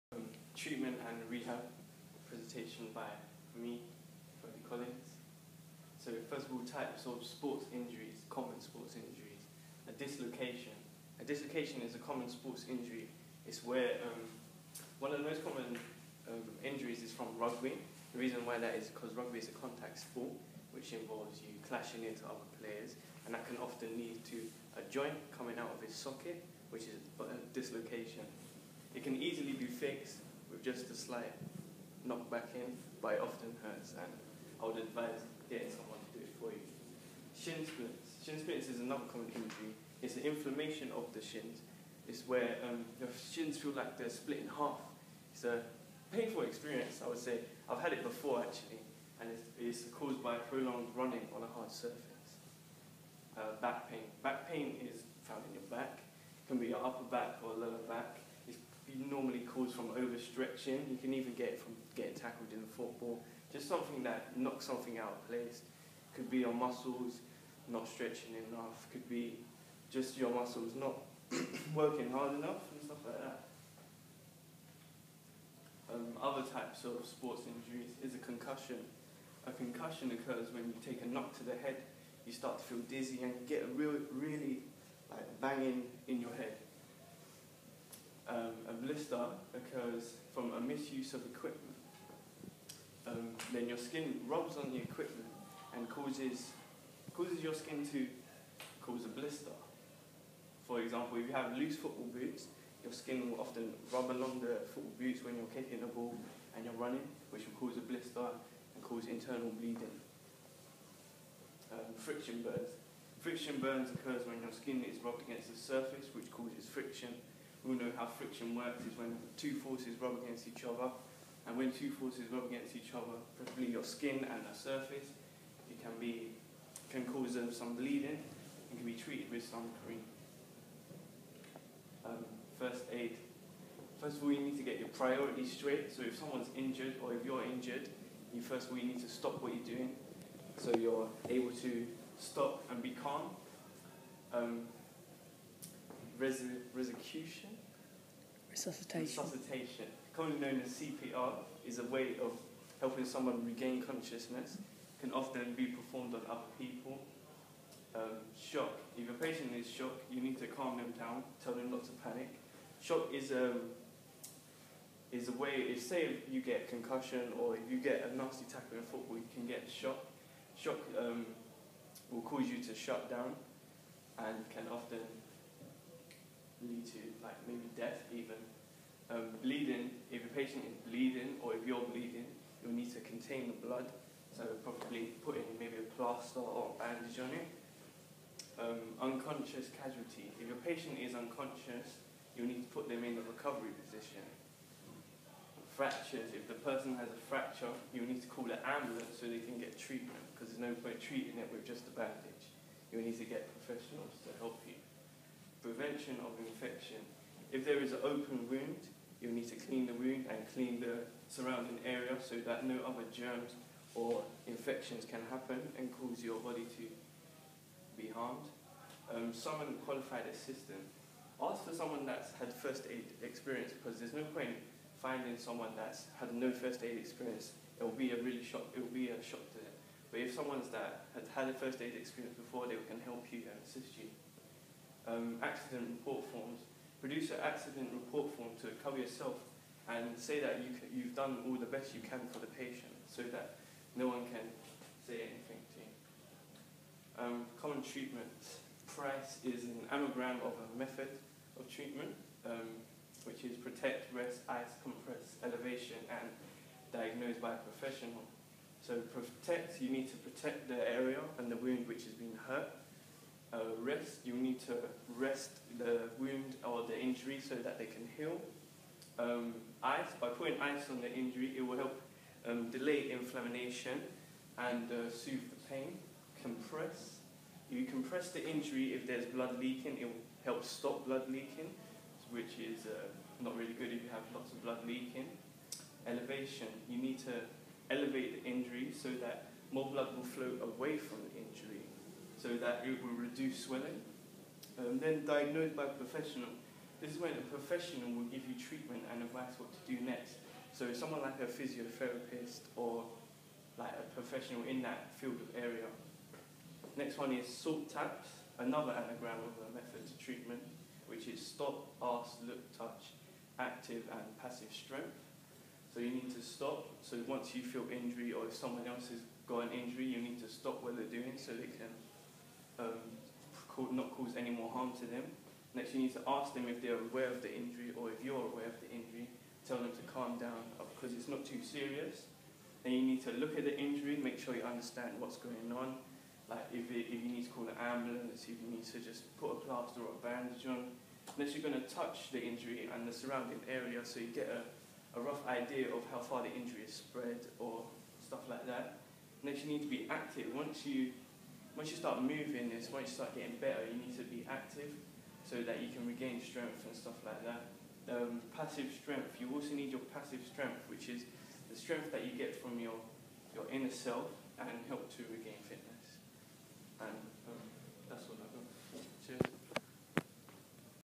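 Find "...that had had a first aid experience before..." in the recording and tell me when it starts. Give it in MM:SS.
03:50.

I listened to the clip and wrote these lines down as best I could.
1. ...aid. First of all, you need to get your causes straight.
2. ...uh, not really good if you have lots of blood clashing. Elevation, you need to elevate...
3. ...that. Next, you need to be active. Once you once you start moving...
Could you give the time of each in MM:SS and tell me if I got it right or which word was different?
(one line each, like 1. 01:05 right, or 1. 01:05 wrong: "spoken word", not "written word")
1. 02:12 wrong: "priorities", not "causes"
2. 04:42 wrong: "leaking", not "clashing"
3. 05:48 right.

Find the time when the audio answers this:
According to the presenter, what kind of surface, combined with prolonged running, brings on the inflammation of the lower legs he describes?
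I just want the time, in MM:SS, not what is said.
00:51.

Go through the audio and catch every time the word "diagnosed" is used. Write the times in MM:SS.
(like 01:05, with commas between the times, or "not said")
04:16, 04:55.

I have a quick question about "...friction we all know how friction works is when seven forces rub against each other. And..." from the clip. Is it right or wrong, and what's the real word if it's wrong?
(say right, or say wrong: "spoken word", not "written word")
wrong: "two", not "seven".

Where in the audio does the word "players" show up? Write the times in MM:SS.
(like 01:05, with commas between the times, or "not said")
00:22.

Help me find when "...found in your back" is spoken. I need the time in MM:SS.
00:55.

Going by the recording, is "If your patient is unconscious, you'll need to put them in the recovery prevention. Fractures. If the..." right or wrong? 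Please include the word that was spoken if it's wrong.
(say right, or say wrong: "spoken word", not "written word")
wrong: "position", not "prevention".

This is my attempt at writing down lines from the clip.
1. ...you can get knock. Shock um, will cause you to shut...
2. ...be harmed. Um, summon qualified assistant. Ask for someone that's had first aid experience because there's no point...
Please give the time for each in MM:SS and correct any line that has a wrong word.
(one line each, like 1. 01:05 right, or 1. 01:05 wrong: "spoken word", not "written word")
1. 02:49 wrong: "shock", not "knock"
2. 03:38 right.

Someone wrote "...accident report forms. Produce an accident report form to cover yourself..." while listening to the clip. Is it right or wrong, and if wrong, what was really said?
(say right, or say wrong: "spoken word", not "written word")
right.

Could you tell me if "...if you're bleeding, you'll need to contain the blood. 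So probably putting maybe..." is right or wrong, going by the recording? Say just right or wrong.
right.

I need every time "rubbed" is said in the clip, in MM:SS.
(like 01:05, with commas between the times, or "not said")
01:55.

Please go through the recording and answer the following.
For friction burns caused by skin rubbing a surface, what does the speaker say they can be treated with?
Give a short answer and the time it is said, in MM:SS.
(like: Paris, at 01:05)
Cream, at 02:09.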